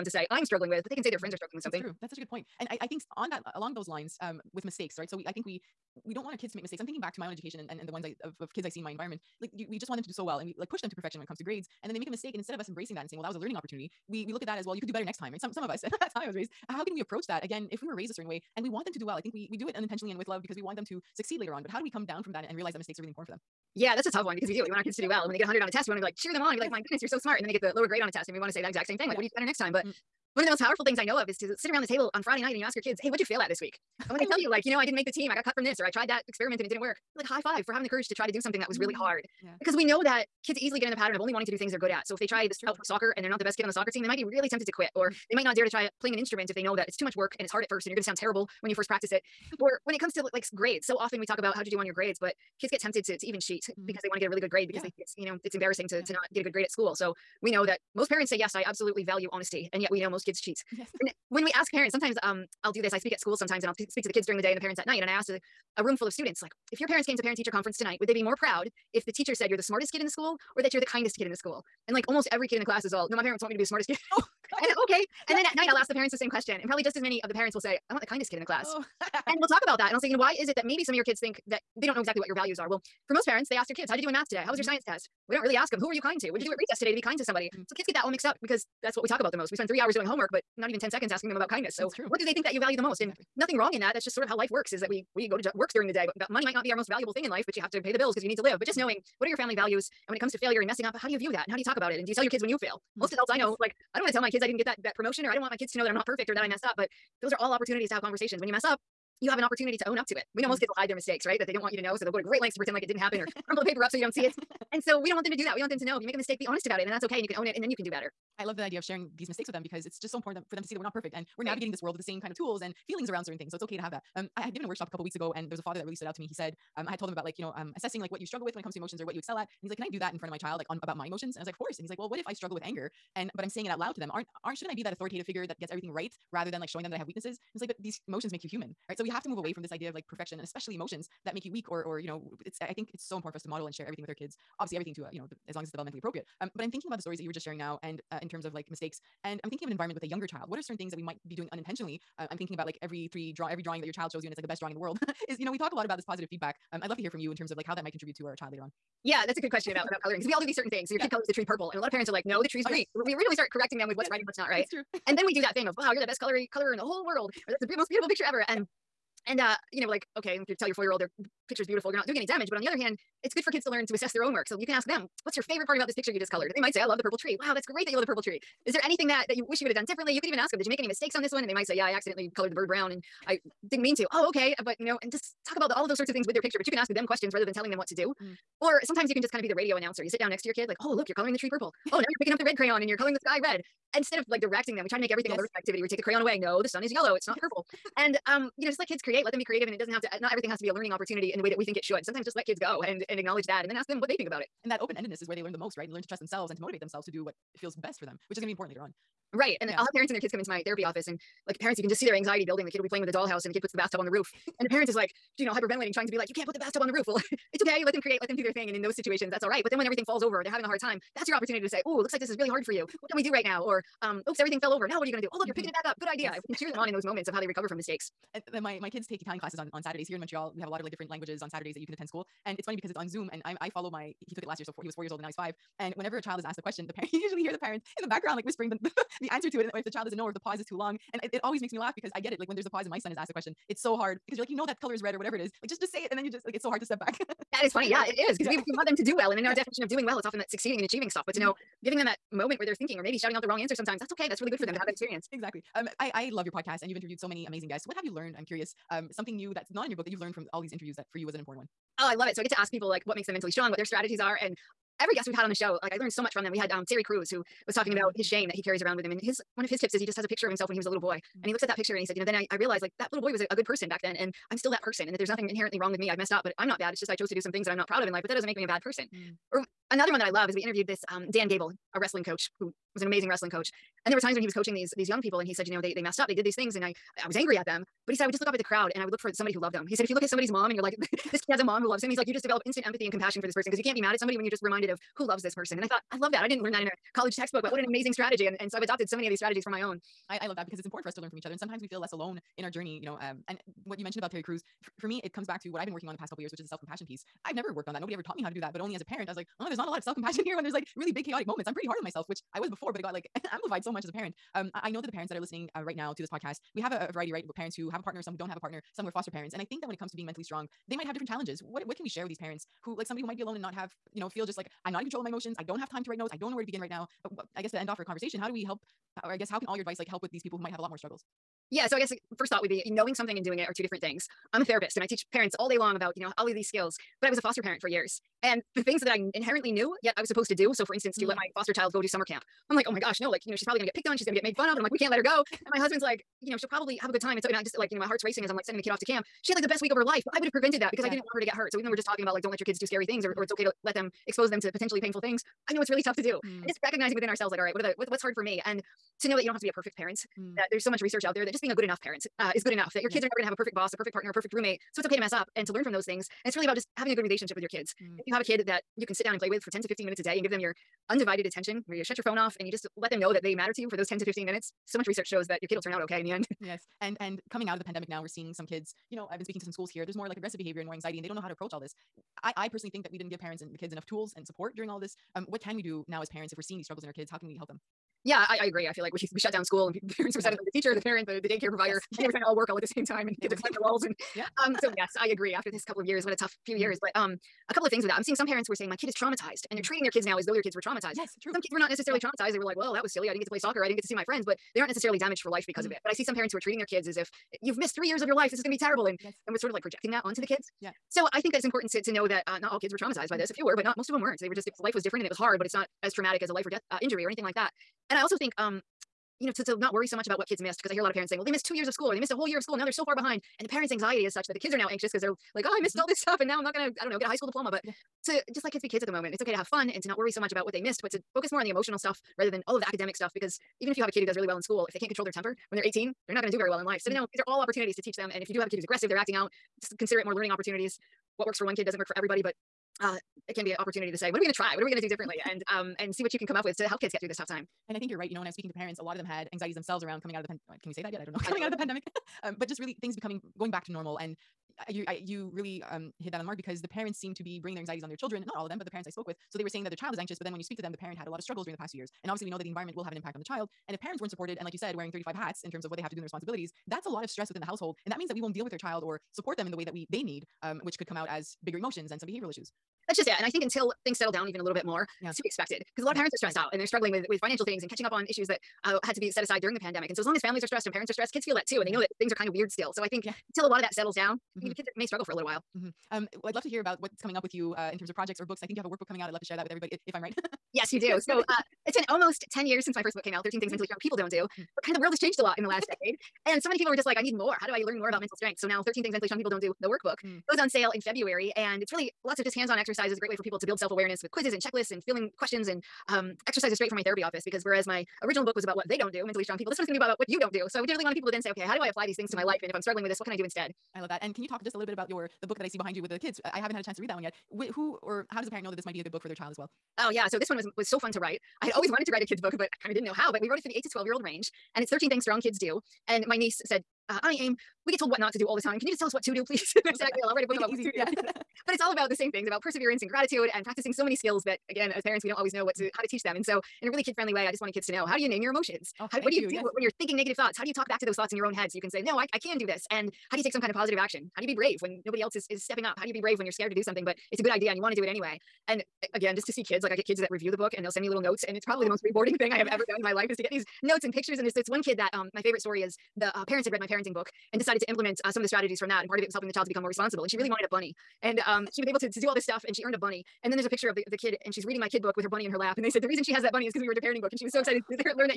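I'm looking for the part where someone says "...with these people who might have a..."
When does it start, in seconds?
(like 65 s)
330 s.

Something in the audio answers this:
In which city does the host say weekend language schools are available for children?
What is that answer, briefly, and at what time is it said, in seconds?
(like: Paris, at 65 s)
Montreal, at 230 s.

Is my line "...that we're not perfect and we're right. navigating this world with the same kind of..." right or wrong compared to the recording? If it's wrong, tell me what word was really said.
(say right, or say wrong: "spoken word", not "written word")
right.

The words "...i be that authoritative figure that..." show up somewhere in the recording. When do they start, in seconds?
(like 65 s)
134 s.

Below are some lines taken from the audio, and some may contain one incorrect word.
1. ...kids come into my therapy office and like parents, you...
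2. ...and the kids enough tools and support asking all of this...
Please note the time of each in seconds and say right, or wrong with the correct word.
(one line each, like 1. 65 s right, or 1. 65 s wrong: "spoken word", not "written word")
1. 210 s right
2. 383 s wrong: "during", not "asking".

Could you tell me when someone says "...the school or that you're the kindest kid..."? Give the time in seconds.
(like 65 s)
70 s.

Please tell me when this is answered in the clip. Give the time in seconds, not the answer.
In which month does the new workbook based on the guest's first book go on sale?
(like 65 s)
501 s.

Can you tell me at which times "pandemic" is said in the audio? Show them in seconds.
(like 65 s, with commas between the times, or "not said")
377 s, 451 s, 479 s.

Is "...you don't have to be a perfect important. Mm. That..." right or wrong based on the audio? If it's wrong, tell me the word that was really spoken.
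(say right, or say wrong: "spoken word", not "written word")
wrong: "parent", not "important".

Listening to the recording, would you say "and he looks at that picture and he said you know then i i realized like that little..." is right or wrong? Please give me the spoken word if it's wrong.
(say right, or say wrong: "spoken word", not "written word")
right.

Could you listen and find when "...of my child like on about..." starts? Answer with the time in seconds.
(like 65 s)
130 s.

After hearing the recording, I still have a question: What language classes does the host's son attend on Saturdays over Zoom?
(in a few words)
Italian.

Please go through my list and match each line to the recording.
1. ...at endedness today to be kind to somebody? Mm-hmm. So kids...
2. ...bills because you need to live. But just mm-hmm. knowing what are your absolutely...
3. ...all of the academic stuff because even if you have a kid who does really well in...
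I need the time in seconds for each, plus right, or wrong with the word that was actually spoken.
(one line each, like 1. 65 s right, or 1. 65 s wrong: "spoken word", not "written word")
1. 86 s wrong: "recess", not "endedness"
2. 97 s wrong: "family", not "absolutely"
3. 432 s right.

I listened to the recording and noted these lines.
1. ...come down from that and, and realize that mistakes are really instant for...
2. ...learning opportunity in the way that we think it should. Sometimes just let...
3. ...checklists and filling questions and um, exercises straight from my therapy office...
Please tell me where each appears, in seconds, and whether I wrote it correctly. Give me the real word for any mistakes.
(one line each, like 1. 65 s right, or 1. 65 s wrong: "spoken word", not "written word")
1. 21 s wrong: "important", not "instant"
2. 200 s right
3. 504 s right.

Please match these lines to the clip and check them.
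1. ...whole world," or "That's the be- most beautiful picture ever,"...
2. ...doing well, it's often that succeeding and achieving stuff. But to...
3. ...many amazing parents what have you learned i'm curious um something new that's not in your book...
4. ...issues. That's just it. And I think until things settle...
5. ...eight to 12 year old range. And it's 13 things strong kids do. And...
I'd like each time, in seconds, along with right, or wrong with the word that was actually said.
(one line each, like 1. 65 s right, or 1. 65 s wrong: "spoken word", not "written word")
1. 166 s right
2. 249 s right
3. 257 s wrong: "guests", not "parents"
4. 472 s right
5. 523 s right.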